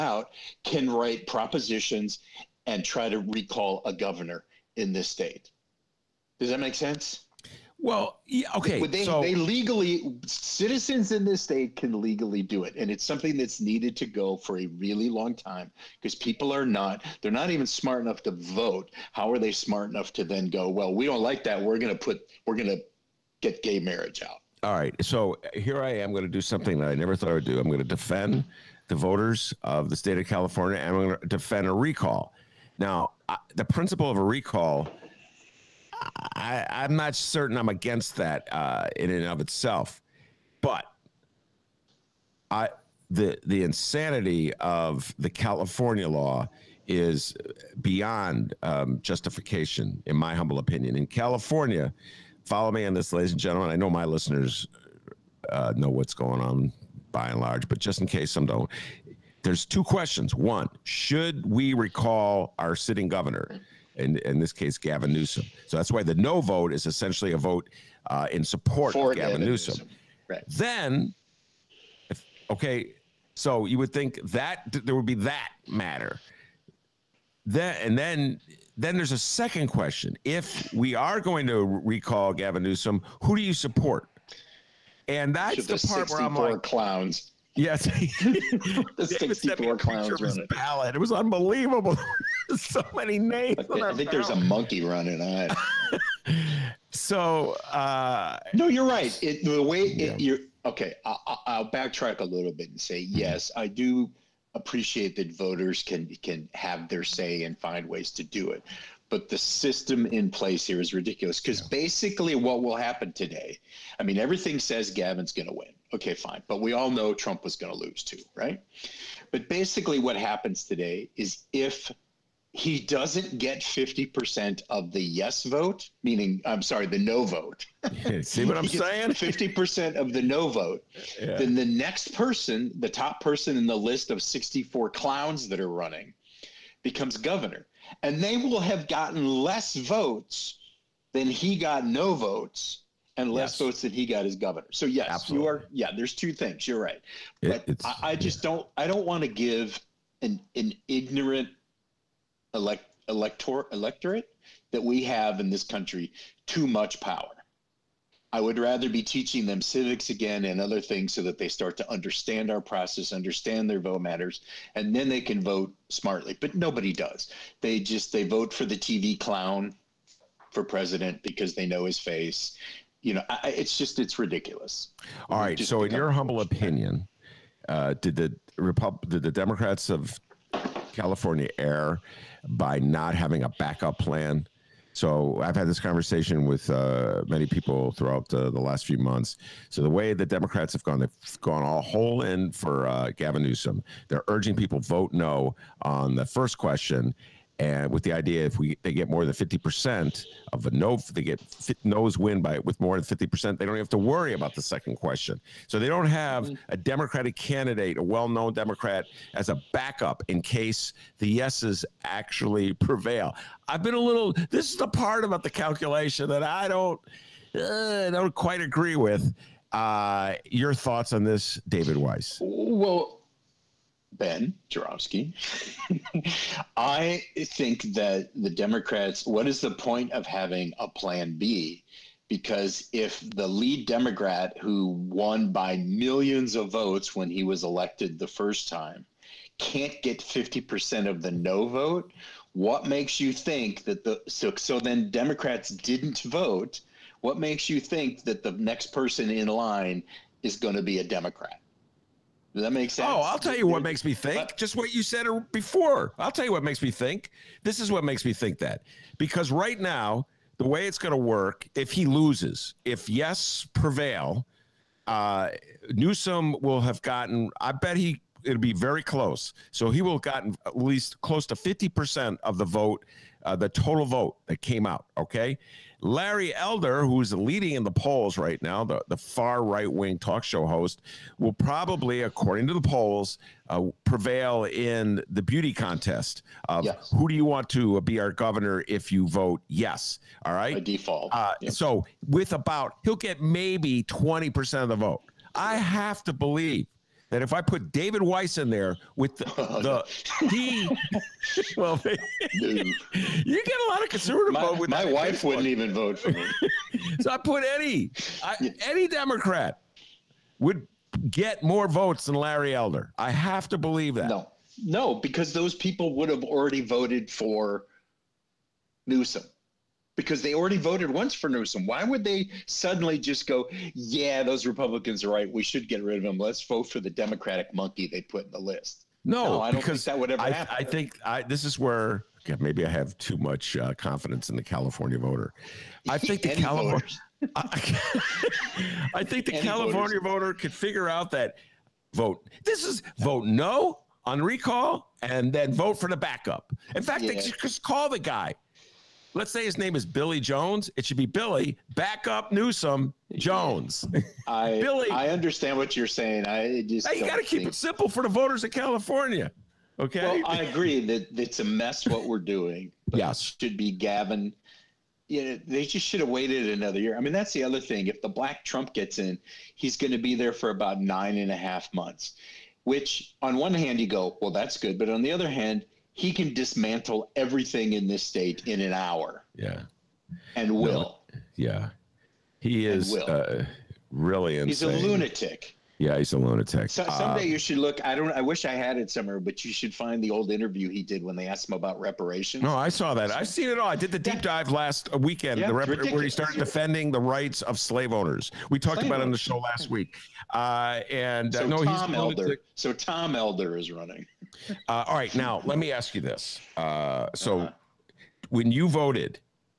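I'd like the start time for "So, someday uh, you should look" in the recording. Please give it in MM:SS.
06:26.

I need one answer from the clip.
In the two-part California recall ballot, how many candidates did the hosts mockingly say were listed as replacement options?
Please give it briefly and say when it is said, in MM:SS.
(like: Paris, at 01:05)
64, at 01:29.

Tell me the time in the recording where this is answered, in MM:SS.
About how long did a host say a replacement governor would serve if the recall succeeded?
06:10.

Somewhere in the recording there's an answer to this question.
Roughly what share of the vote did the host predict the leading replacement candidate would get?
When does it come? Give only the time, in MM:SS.
04:54.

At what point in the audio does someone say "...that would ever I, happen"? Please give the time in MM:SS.
05:30.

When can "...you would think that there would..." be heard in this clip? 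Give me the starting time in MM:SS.
01:13.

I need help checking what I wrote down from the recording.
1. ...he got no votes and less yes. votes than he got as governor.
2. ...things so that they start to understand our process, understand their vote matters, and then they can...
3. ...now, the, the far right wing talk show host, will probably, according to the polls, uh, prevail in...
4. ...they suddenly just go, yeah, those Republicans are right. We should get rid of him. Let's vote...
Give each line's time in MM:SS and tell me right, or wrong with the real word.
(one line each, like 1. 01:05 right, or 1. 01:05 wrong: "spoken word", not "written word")
1. 02:21 right
2. 02:40 right
3. 04:38 right
4. 05:22 right.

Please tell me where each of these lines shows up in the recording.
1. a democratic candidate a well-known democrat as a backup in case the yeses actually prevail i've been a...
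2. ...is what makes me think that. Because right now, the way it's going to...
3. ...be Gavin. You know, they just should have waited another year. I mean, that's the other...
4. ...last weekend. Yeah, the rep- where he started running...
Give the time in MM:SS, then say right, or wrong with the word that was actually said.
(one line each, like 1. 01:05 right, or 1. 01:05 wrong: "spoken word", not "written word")
1. 03:26 right
2. 04:17 right
3. 06:03 right
4. 06:34 wrong: "defending", not "running".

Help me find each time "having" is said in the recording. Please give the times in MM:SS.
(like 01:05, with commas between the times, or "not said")
03:03, 03:50.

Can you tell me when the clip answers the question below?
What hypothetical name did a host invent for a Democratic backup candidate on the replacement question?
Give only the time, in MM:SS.
05:50.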